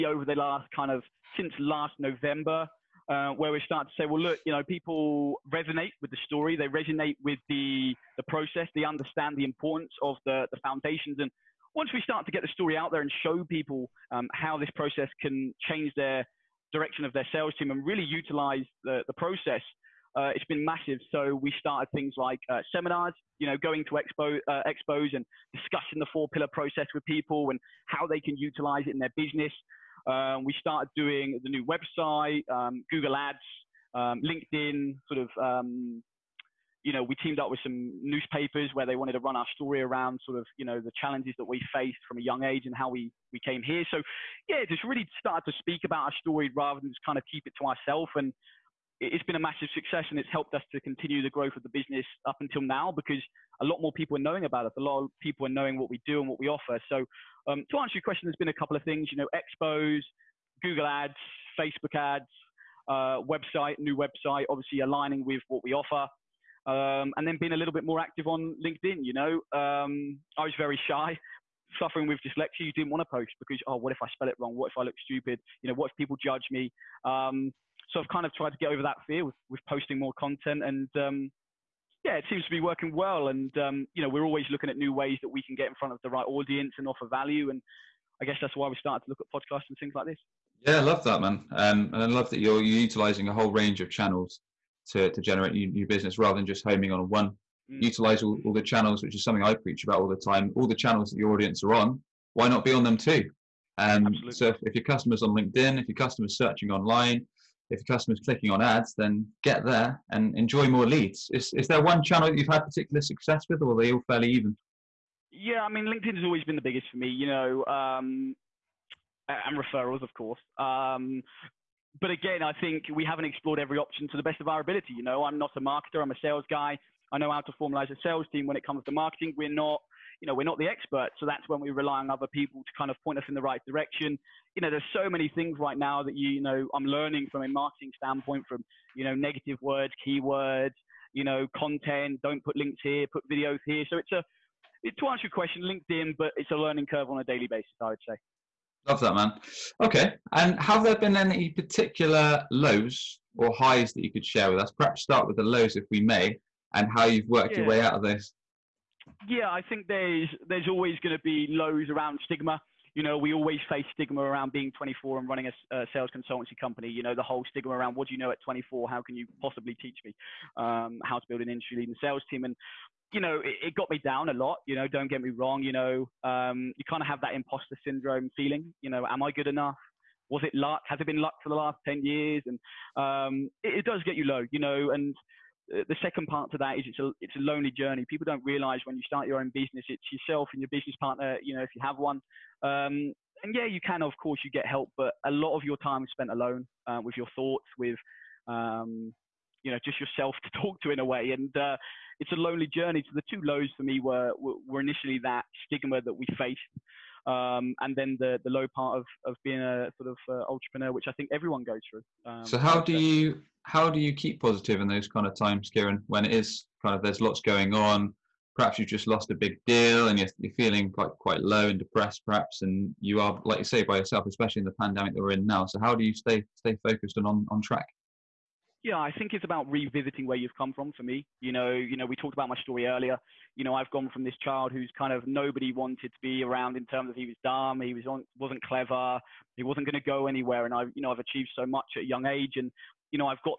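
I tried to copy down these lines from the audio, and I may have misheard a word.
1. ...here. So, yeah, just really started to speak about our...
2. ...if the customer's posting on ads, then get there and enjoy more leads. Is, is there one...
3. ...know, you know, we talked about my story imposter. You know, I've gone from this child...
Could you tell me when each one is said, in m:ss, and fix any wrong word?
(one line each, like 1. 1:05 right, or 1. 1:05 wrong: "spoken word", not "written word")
1. 0:43 right
2. 1:47 wrong: "clicking", not "posting"
3. 3:51 wrong: "earlier", not "imposter".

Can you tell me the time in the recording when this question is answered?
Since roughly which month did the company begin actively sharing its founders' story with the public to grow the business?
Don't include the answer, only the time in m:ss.
0:01.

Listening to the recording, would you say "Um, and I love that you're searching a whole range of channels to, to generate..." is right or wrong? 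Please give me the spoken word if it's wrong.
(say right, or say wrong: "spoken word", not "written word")
wrong: "utilizing", not "searching".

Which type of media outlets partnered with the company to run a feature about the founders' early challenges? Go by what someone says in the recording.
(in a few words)
newspapers.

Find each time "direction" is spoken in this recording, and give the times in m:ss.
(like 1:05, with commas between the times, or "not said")
0:16, 2:13.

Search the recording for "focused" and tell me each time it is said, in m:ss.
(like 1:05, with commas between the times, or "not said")
3:46.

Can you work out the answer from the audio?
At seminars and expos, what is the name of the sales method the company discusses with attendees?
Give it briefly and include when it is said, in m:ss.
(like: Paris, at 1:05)
four pillar process, at 0:26.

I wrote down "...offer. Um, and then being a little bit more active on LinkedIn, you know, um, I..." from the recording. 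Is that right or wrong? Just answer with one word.
right.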